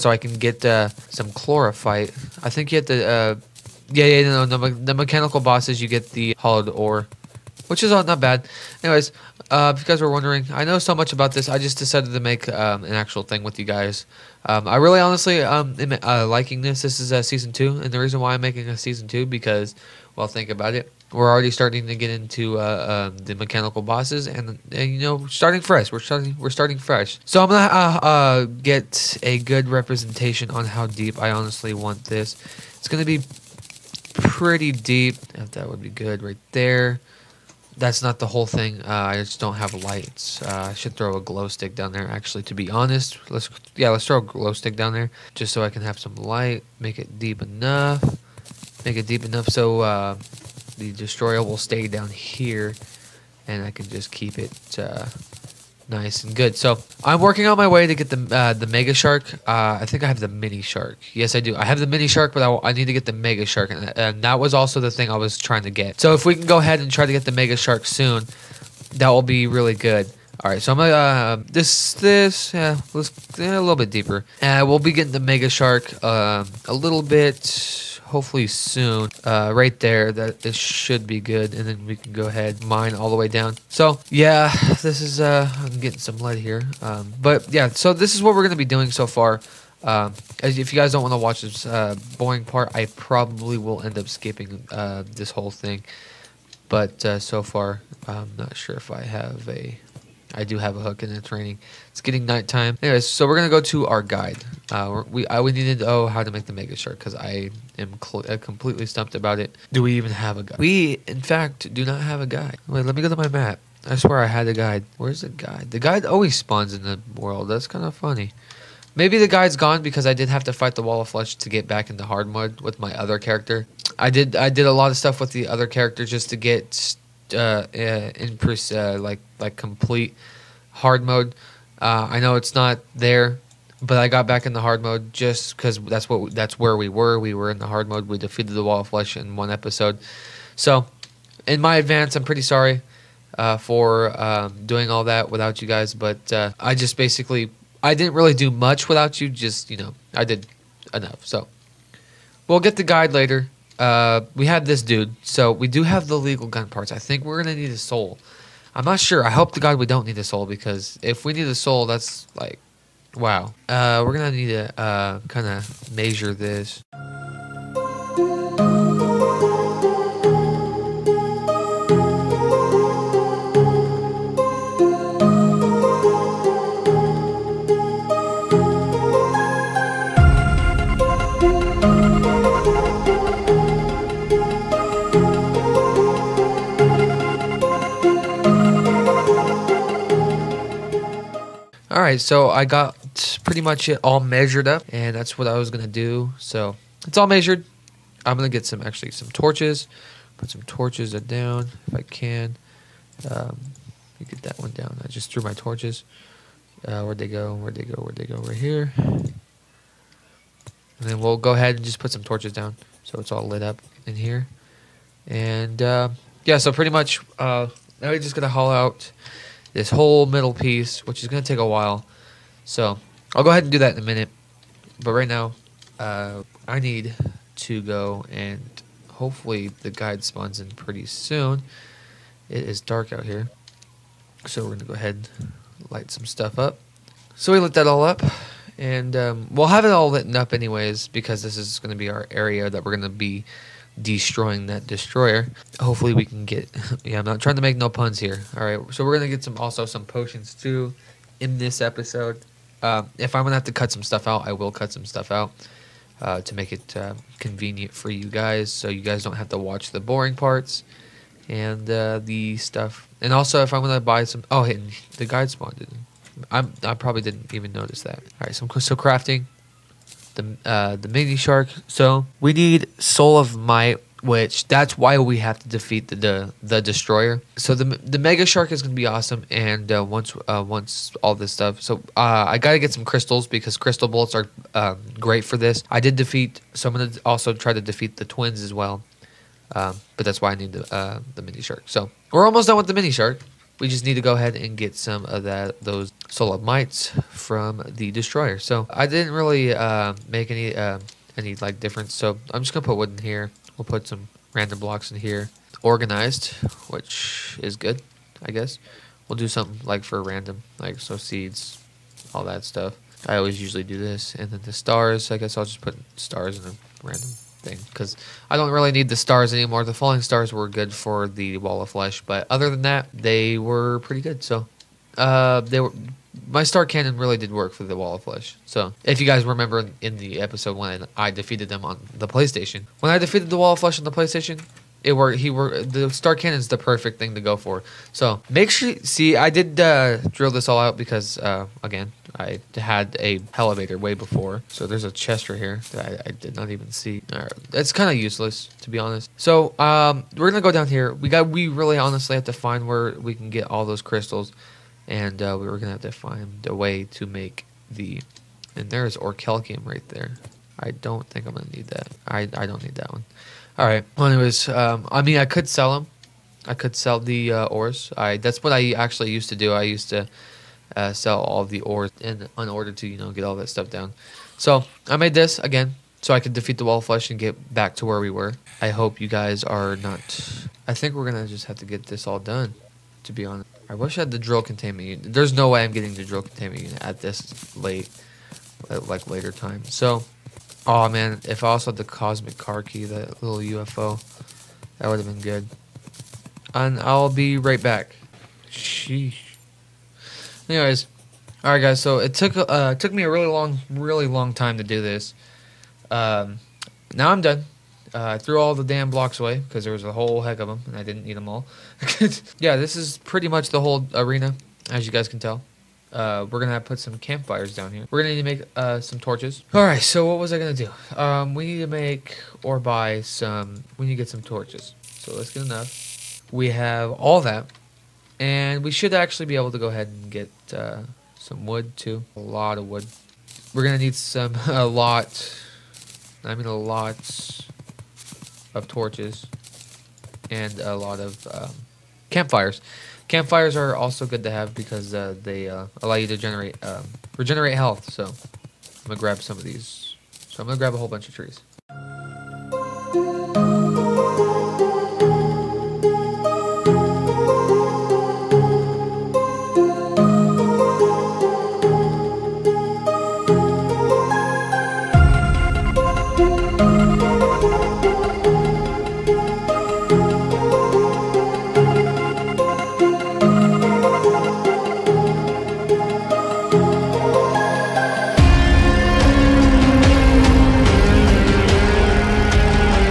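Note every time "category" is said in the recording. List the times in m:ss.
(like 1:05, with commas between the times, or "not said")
not said.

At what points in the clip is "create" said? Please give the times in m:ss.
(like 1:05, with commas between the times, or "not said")
not said.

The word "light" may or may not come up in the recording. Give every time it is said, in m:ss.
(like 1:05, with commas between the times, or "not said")
0:39, 0:46, 3:55.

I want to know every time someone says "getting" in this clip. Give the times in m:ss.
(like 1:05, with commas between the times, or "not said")
1:14, 1:25, 1:41, 6:25.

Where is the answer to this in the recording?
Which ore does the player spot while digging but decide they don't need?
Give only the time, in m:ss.
5:59.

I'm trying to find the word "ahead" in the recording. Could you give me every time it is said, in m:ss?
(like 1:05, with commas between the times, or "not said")
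1:06, 1:22, 3:31, 3:43, 3:54, 4:54, 7:09.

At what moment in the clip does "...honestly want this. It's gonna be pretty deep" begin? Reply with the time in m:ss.
0:31.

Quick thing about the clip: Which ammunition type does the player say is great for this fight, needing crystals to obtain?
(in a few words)
Crystal bolts.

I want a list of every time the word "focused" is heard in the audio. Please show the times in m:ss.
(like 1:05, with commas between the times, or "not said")
not said.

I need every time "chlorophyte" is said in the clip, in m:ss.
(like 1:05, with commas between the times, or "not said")
0:01.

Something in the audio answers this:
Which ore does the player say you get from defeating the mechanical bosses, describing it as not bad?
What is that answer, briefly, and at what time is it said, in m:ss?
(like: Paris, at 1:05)
Hallowed ore, at 0:06.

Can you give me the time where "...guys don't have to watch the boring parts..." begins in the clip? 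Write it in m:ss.
4:19.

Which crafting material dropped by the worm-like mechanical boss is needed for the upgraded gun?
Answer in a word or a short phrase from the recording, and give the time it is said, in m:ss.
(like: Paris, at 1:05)
Soul of Might, at 4:33.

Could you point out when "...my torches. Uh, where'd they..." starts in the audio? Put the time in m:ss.
3:25.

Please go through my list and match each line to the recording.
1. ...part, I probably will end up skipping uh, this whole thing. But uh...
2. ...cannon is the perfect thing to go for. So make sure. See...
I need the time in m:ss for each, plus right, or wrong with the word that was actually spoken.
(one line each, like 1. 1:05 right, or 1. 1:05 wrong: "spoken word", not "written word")
1. 1:32 right
2. 5:36 right.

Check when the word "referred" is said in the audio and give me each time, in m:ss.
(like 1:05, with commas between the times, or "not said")
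not said.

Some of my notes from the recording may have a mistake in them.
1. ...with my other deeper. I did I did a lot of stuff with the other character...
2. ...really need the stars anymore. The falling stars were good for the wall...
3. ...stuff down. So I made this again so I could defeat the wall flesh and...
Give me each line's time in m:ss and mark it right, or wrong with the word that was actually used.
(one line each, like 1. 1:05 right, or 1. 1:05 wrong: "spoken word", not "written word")
1. 2:02 wrong: "character", not "deeper"
2. 5:18 right
3. 6:13 wrong: "flush", not "flesh".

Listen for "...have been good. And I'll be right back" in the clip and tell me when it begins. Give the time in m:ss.
6:35.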